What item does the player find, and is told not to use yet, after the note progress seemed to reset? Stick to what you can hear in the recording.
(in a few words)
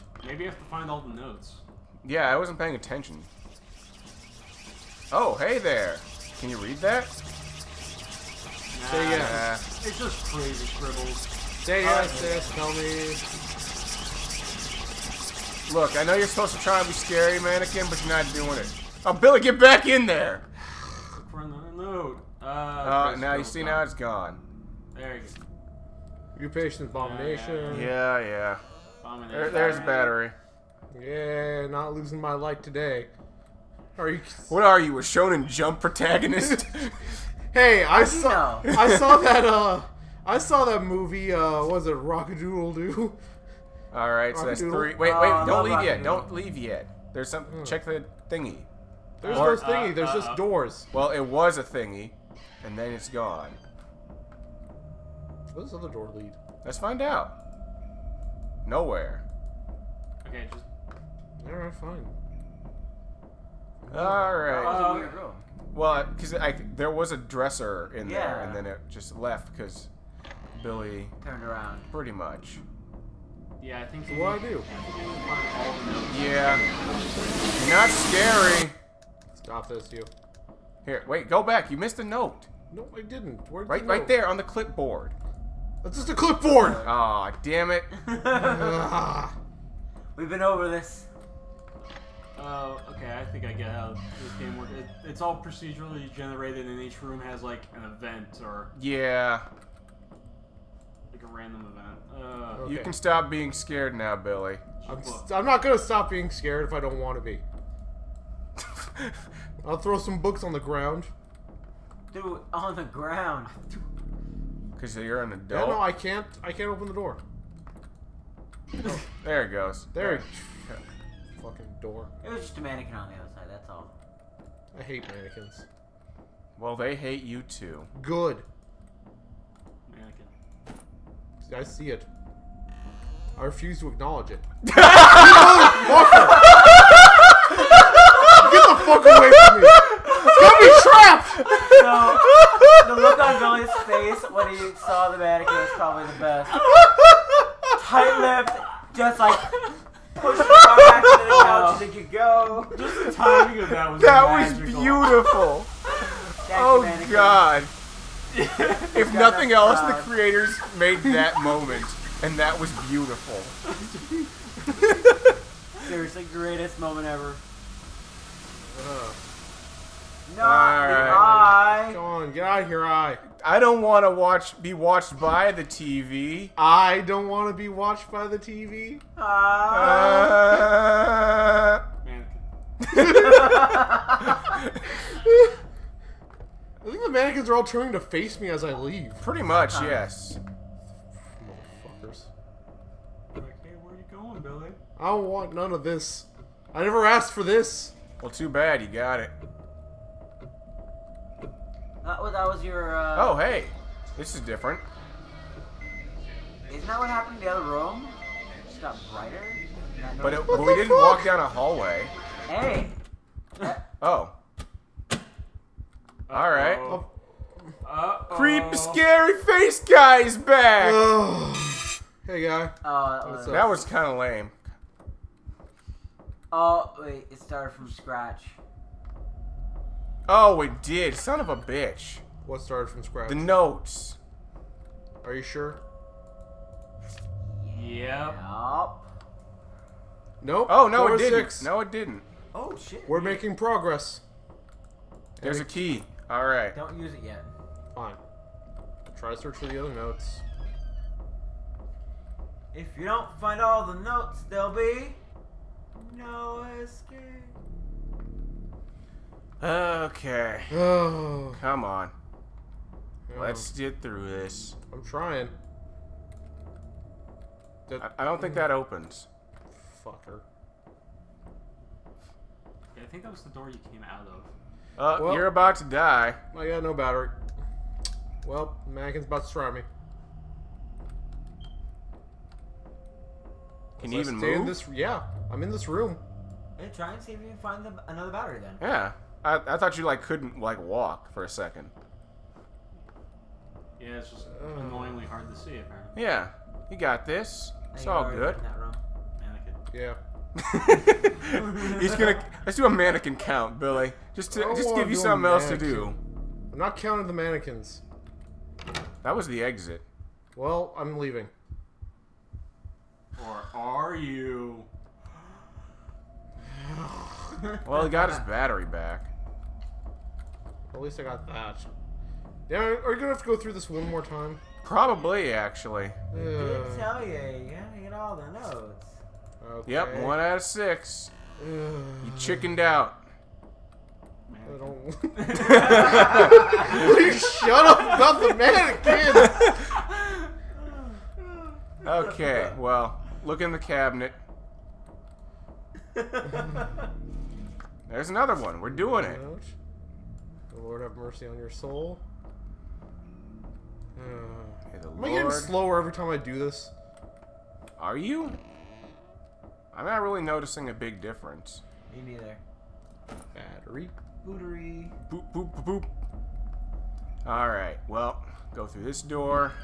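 A key.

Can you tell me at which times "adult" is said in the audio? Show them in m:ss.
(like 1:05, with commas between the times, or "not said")
1:55.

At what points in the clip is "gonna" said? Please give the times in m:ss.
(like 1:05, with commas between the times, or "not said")
1:45, 5:02, 5:23.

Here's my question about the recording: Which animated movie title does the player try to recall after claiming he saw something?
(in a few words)
Rock-a-Doodle.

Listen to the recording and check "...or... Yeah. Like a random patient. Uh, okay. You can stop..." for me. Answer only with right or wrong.
wrong.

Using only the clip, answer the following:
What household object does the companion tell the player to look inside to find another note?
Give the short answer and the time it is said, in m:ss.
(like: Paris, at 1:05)
Cabinet, at 5:43.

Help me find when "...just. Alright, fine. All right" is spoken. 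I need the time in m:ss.
1:00.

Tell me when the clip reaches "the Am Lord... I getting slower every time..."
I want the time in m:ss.
5:54.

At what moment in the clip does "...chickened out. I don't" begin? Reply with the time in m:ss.
5:32.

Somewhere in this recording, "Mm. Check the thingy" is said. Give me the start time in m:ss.
0:47.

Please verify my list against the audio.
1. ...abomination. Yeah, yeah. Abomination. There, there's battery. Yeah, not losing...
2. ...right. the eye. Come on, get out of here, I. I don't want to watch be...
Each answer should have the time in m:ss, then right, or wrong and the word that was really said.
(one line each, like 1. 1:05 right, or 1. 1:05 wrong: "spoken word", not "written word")
1. 0:26 right
2. 2:50 right.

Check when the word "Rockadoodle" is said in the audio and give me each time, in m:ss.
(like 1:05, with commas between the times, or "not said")
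0:41.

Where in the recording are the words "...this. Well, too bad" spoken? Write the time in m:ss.
3:17.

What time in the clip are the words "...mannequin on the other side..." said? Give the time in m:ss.
2:02.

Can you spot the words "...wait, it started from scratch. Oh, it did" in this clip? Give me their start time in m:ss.
3:46.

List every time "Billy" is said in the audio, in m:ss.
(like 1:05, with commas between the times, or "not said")
0:19, 1:10, 1:44, 3:14, 5:03.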